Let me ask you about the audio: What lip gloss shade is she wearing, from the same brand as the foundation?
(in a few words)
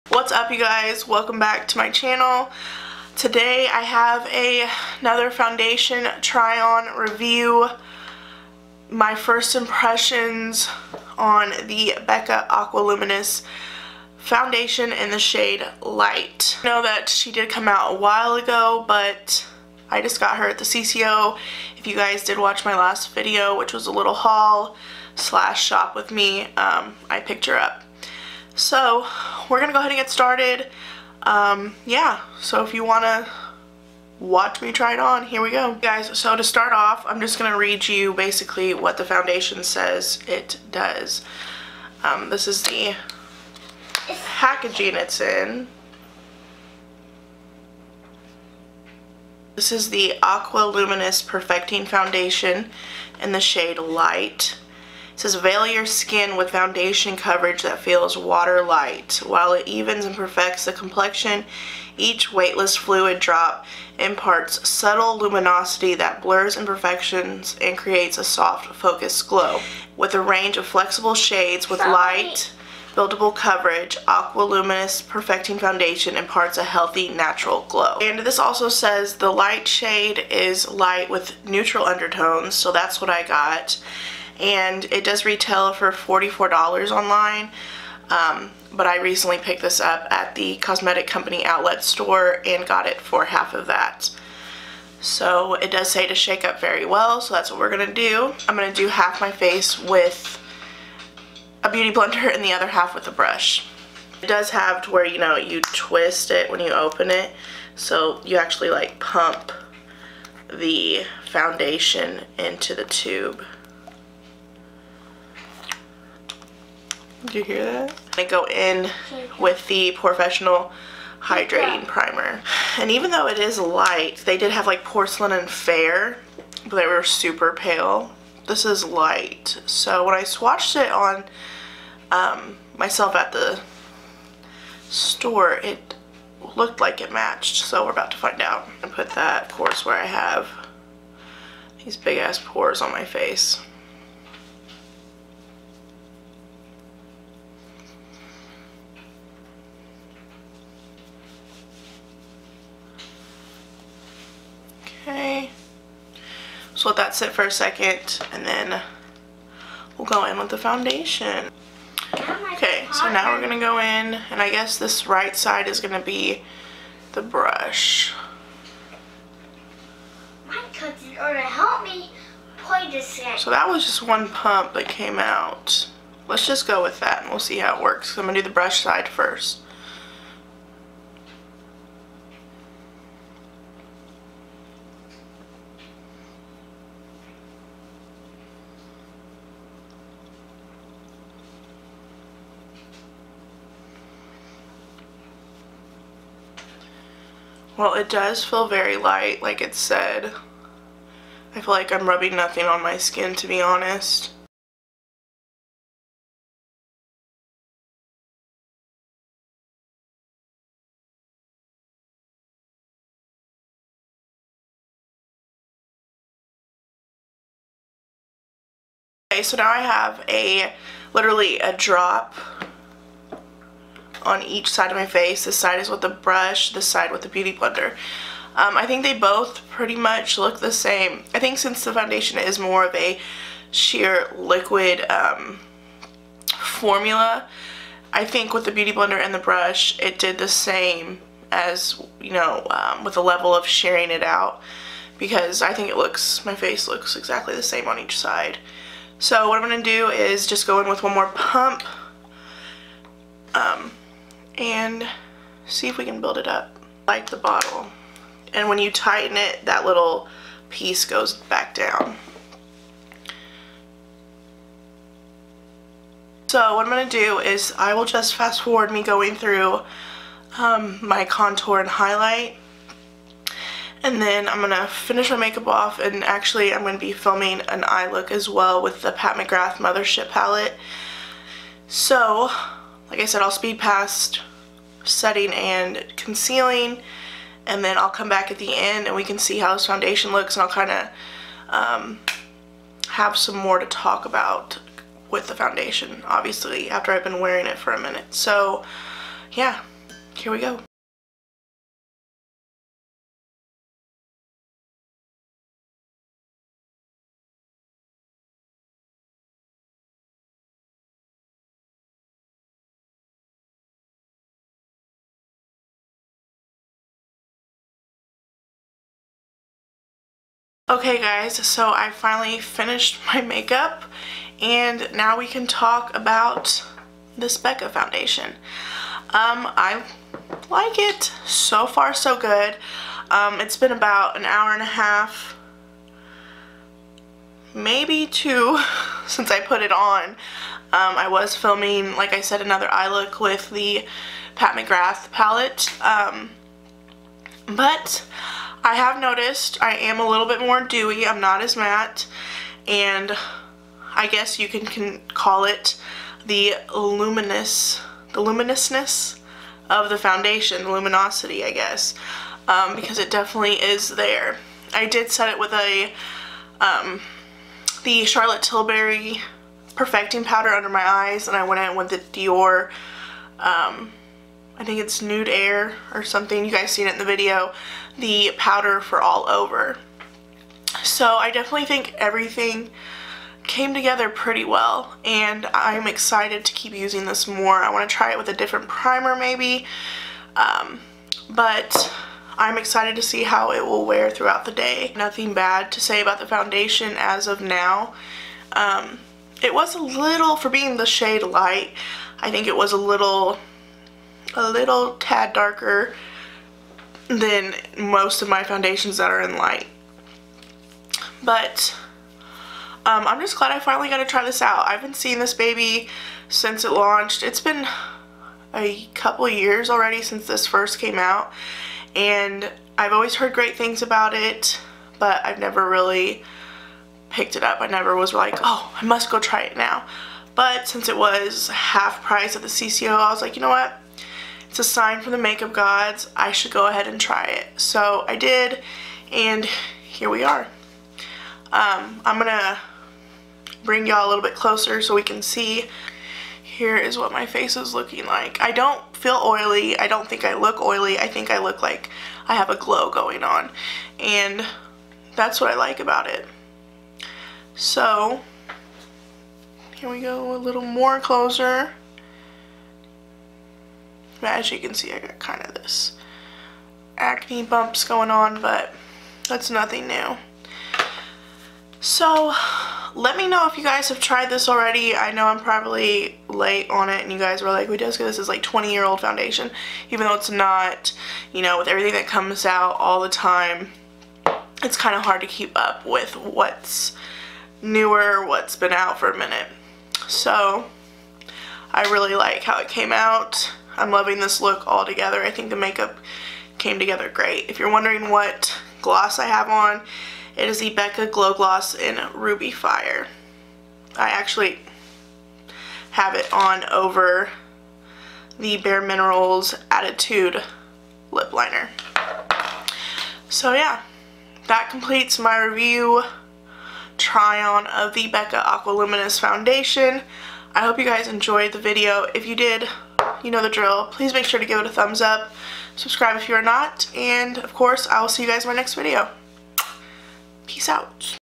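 Ruby Fire.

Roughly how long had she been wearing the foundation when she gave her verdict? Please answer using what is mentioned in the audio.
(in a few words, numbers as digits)
an hour and a half.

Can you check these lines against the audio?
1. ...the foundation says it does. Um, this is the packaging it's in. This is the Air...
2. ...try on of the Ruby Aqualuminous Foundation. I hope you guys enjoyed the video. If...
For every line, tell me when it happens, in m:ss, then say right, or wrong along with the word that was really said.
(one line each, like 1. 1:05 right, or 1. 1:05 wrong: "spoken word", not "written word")
1. 0:38 wrong: "Aqua", not "Air"
2. 8:37 wrong: "Becca", not "Ruby".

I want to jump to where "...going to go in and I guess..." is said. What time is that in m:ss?
2:43.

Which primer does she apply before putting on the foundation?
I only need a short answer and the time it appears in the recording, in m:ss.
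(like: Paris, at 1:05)
POREfessional Hydrating Primer, at 1:59.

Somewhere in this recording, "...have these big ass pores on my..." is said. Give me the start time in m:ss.
2:20.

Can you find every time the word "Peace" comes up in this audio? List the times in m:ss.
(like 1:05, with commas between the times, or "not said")
8:50.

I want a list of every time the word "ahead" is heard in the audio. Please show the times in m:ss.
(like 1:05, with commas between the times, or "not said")
0:29, 7:16.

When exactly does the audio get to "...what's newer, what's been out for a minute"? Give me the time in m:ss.
8:06.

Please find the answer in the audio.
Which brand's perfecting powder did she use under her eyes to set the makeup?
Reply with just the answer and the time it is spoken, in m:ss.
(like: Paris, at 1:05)
Charlotte Tilbury, at 6:08.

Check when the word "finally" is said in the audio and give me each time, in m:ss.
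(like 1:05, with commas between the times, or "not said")
5:22, 6:53.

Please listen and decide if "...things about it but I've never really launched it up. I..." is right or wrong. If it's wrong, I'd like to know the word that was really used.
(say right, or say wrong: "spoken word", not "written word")
wrong: "picked", not "launched".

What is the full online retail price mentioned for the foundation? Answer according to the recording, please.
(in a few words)
$44.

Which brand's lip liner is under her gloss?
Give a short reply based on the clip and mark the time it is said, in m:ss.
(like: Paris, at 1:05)
Bare Minerals, at 8:28.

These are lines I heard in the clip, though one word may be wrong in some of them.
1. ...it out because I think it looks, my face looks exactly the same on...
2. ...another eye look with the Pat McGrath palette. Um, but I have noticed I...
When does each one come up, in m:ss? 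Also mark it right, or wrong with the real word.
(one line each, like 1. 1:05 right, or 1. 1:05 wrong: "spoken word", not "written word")
1. 4:04 right
2. 5:42 right.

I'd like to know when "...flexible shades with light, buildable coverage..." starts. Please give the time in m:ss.
1:10.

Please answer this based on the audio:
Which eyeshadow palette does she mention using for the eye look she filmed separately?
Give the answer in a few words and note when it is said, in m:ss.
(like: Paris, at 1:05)
Pat McGrath Mothership, at 4:39.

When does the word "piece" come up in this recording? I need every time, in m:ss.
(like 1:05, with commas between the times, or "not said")
4:20.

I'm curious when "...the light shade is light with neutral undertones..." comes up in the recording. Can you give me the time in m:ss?
1:19.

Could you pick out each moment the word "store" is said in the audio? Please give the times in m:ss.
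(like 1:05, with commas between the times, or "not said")
1:31, 2:14.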